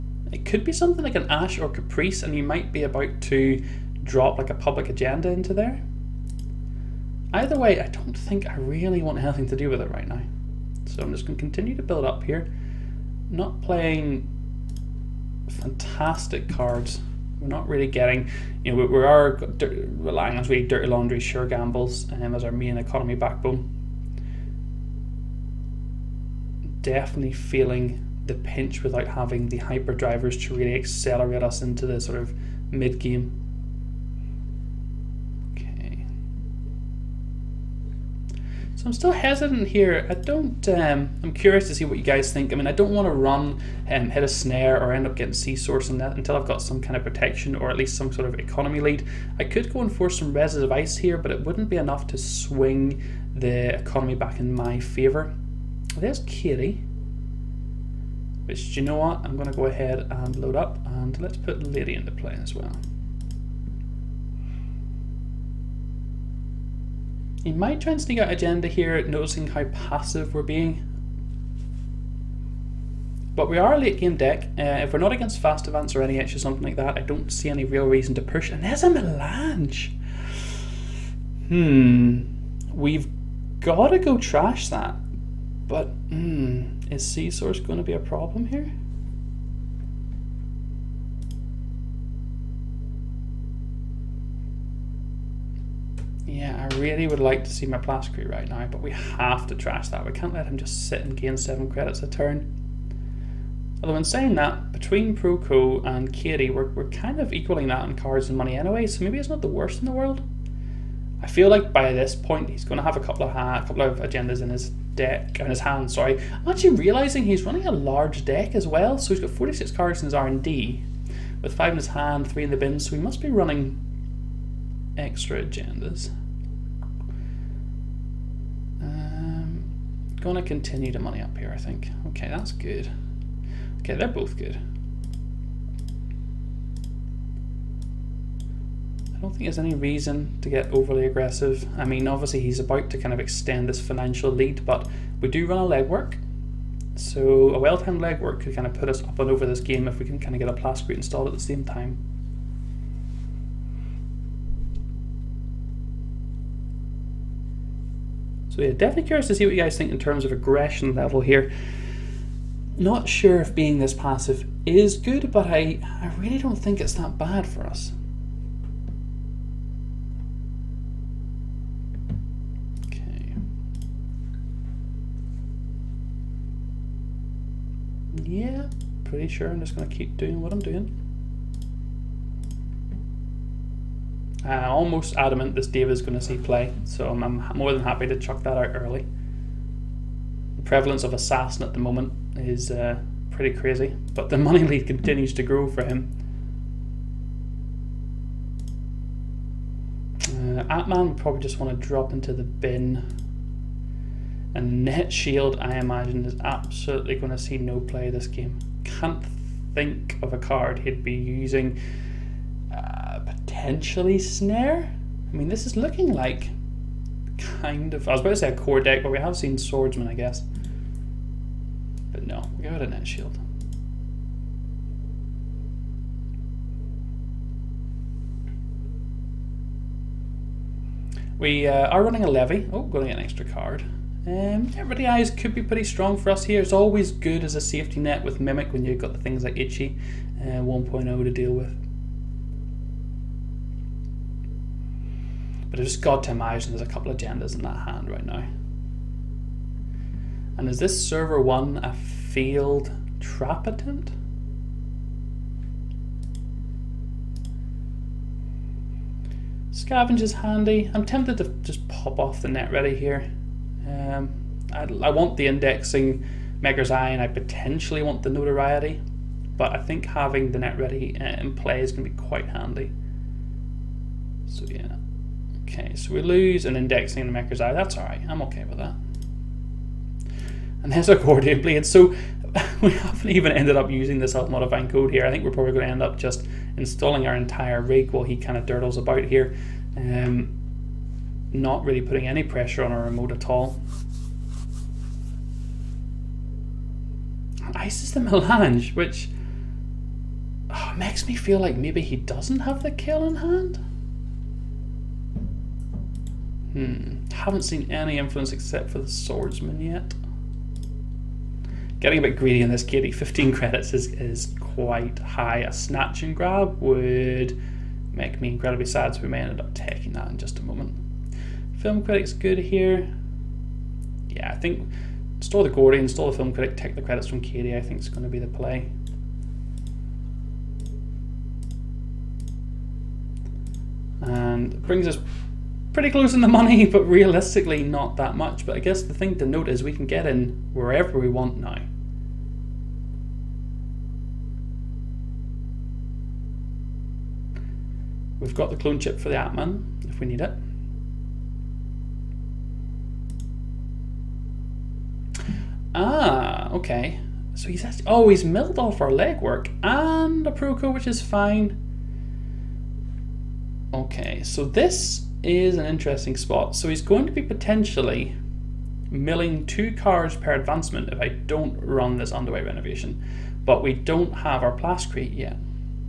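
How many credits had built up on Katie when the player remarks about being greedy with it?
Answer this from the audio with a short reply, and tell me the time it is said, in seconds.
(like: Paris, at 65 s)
15, at 313 s.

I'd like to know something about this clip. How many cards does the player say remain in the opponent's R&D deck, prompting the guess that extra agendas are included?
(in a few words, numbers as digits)
46.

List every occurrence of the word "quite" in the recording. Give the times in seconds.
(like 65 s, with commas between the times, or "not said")
272 s, 314 s.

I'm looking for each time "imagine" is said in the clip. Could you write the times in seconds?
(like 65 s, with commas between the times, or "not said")
205 s, 246 s.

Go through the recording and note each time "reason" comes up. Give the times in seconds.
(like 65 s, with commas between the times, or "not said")
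77 s, 139 s.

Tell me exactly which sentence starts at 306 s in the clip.
Hmm, haven't seen any influence except for the swordsman yet.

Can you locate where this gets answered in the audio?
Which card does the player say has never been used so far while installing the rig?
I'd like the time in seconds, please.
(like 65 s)
284 s.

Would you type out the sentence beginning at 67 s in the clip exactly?
He might try and sneak out agenda here, noticing how passive we're being.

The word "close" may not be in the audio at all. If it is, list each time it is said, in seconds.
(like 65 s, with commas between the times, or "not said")
336 s.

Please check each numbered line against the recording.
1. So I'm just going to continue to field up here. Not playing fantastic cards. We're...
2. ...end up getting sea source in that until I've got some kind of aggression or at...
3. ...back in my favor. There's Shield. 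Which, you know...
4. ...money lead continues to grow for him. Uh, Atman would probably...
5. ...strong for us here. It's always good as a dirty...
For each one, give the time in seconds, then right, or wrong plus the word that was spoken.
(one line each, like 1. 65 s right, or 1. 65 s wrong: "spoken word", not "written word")
1. 10 s wrong: "build", not "field"
2. 44 s wrong: "protection", not "aggression"
3. 54 s wrong: "Katie", not "Shield"
4. 194 s right
5. 235 s wrong: "safety", not "dirty".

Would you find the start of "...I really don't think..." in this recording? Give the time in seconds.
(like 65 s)
166 s.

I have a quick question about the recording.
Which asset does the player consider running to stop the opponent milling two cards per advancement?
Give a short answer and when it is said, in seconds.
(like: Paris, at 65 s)
Underway Renovation, at 372 s.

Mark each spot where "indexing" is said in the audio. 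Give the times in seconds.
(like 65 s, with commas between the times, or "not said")
265 s, 276 s.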